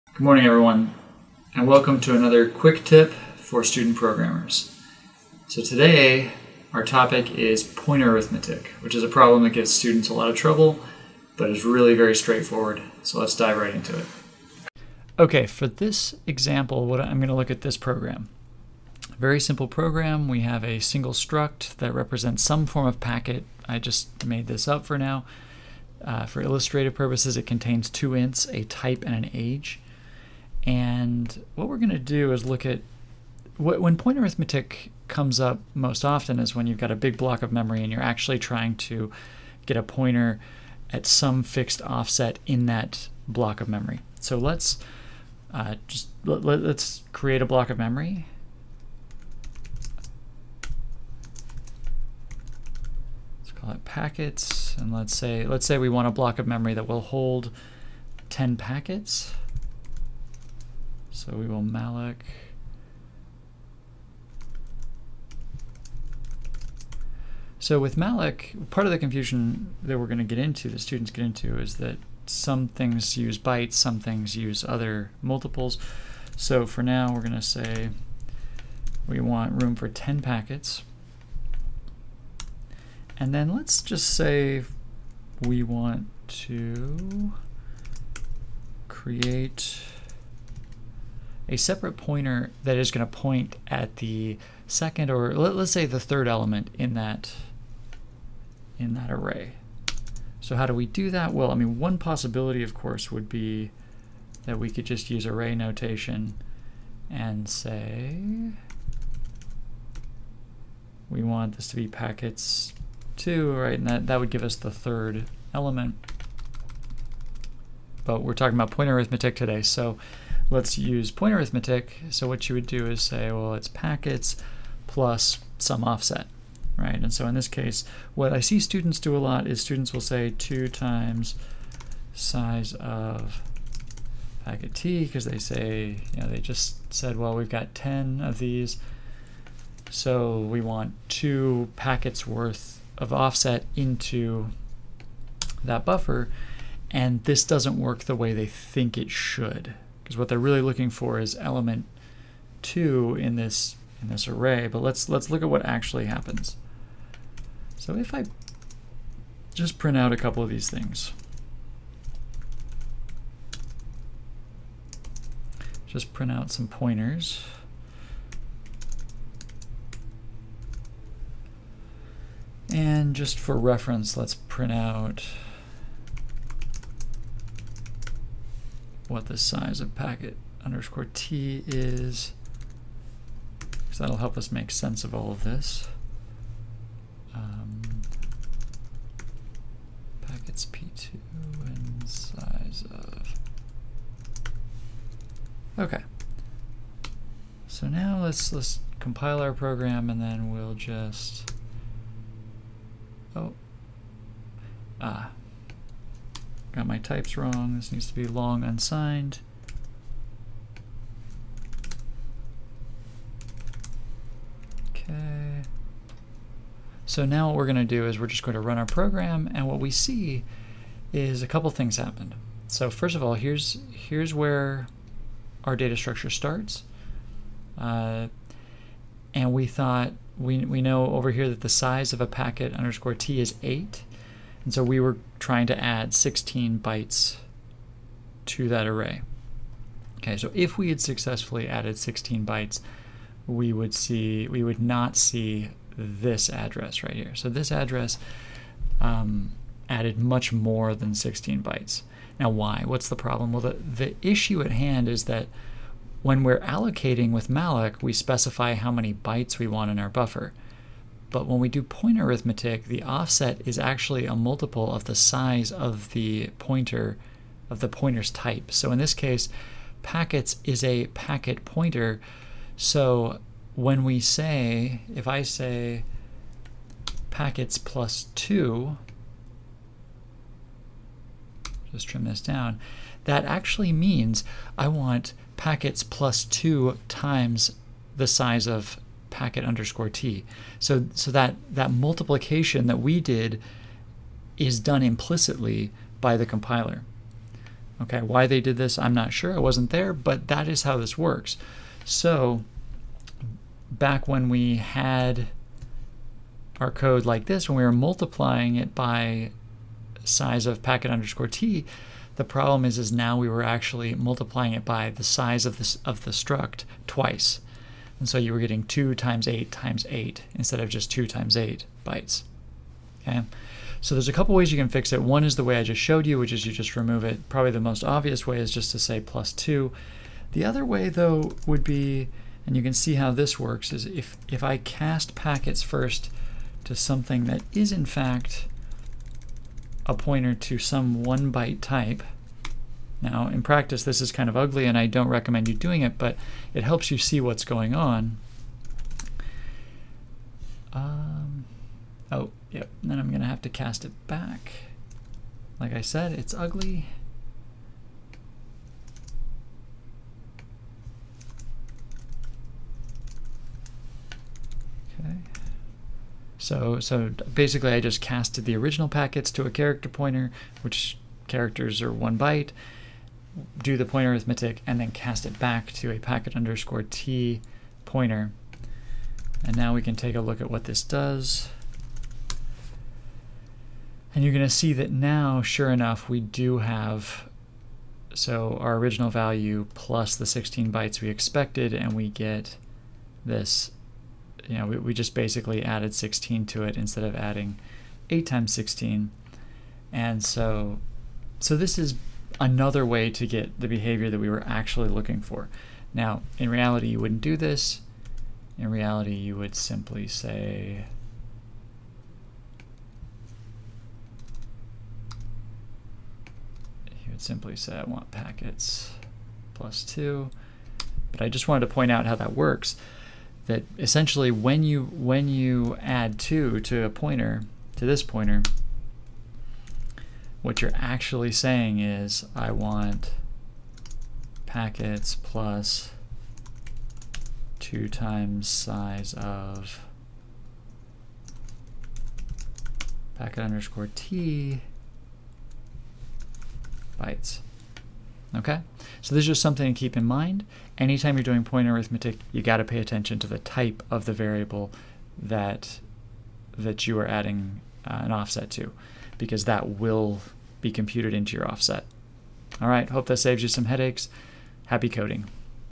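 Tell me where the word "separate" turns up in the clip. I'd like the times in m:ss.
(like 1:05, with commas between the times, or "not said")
1:31.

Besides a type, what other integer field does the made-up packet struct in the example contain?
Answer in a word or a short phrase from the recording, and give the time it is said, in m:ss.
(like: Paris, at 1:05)
age, at 0:29.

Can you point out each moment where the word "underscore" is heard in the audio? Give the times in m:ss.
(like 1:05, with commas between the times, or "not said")
3:00, 3:52, 4:49, 5:11, 6:16, 7:23.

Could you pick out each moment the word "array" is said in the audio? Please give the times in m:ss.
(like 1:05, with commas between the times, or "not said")
1:39, 1:45, 2:34, 3:58.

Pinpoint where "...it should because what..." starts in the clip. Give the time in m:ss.
2:28.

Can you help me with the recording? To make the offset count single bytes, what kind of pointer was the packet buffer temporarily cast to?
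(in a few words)
character pointer.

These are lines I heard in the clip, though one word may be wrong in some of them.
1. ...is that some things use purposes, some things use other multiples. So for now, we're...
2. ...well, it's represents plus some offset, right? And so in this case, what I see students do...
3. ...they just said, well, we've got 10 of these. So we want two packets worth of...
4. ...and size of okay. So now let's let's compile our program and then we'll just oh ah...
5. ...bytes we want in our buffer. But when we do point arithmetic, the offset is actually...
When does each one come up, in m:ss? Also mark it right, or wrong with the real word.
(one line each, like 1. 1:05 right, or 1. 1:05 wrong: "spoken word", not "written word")
1. 1:11 wrong: "bytes", not "purposes"
2. 2:03 wrong: "packets", not "represents"
3. 2:16 right
4. 3:11 right
5. 4:19 right.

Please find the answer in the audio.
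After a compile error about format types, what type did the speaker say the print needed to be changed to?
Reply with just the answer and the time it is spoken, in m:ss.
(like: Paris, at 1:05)
long unsigned, at 3:28.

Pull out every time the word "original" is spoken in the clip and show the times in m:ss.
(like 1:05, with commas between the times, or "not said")
6:08, 6:28.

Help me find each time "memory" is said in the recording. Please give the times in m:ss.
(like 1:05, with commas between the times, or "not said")
0:37, 0:43, 0:47, 0:56.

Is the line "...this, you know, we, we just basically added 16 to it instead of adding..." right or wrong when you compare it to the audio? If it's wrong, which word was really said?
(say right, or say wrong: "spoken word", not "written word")
right.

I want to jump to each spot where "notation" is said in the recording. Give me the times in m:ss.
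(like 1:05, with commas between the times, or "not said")
1:45.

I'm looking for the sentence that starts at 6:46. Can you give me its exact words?
Now, in reality, you wouldn't do this.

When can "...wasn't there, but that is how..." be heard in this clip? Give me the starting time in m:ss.
4:59.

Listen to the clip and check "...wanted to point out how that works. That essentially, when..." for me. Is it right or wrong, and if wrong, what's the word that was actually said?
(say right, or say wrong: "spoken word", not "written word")
right.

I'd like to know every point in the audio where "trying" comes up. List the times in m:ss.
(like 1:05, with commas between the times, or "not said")
0:38, 3:55.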